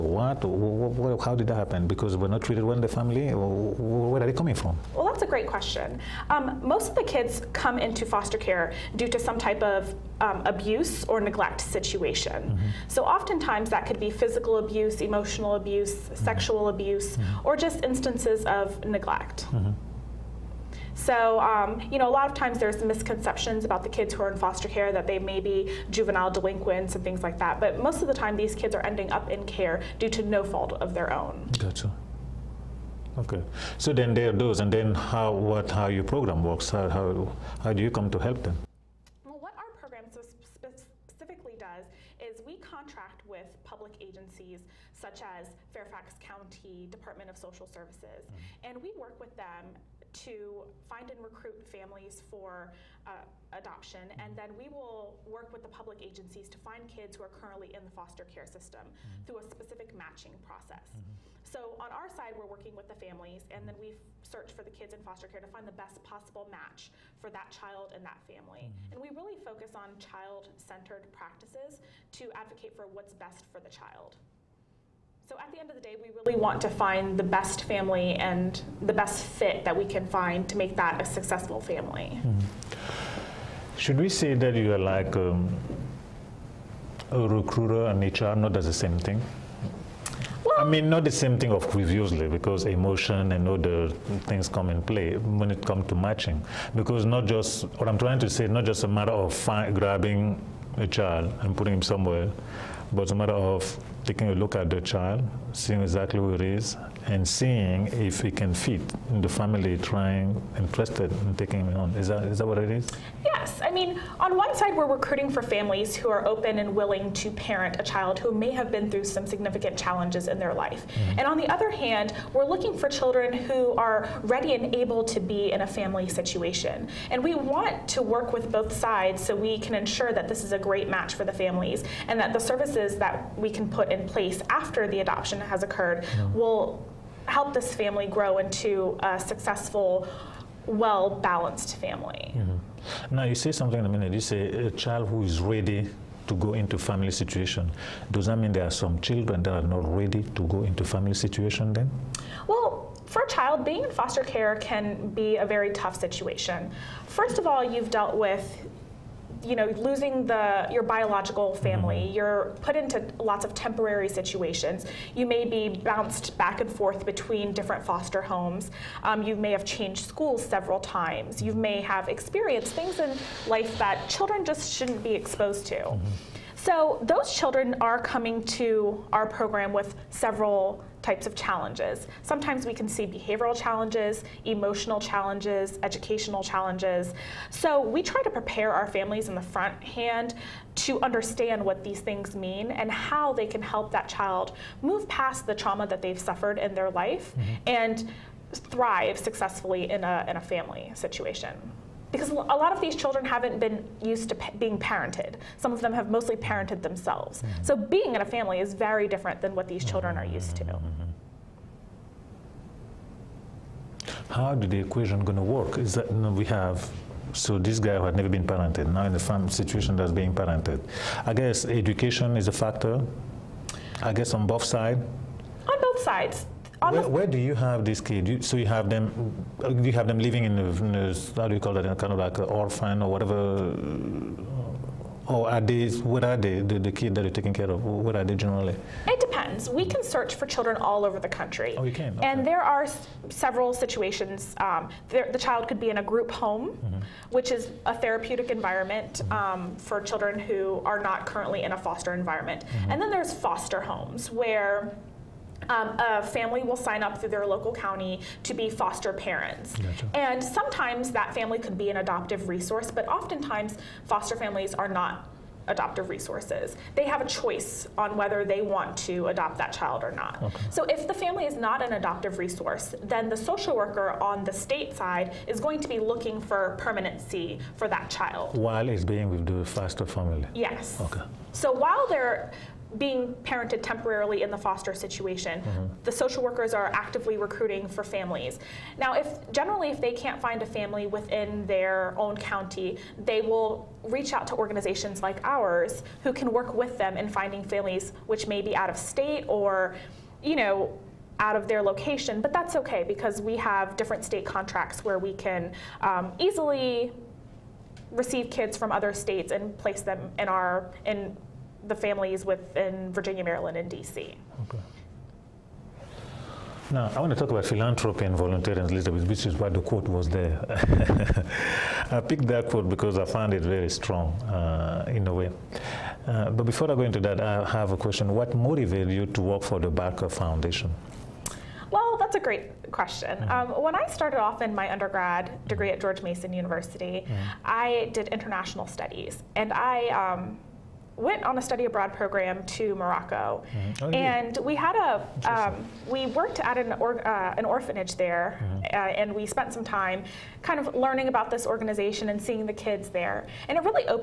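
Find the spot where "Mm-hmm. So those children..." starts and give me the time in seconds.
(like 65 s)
175 s.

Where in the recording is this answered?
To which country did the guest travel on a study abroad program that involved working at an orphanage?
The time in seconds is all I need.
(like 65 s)
342 s.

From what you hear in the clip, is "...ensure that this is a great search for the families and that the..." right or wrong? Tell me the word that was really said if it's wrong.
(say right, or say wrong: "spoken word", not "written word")
wrong: "match", not "search".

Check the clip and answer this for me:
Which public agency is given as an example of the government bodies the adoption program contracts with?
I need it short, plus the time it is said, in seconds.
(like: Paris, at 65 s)
Fairfax County Department of Social Services, at 45 s.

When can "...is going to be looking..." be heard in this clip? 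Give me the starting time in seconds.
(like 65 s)
275 s.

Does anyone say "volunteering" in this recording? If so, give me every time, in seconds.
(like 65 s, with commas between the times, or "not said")
318 s.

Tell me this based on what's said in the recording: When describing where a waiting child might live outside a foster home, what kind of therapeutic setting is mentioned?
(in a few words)
group home.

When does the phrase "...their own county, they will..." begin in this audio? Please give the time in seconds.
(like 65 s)
291 s.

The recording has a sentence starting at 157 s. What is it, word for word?
First of all, you've dealt with you know, losing the your biological family, mm-hmm.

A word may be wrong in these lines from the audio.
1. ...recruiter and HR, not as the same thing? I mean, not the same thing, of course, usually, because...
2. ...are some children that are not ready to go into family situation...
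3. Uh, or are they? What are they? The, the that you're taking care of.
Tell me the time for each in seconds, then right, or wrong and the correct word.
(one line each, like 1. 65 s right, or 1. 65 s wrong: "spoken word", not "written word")
1. 87 s right
2. 148 s right
3. 233 s right.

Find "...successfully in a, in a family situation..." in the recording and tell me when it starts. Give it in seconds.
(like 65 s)
199 s.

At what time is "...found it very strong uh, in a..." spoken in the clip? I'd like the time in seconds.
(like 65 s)
323 s.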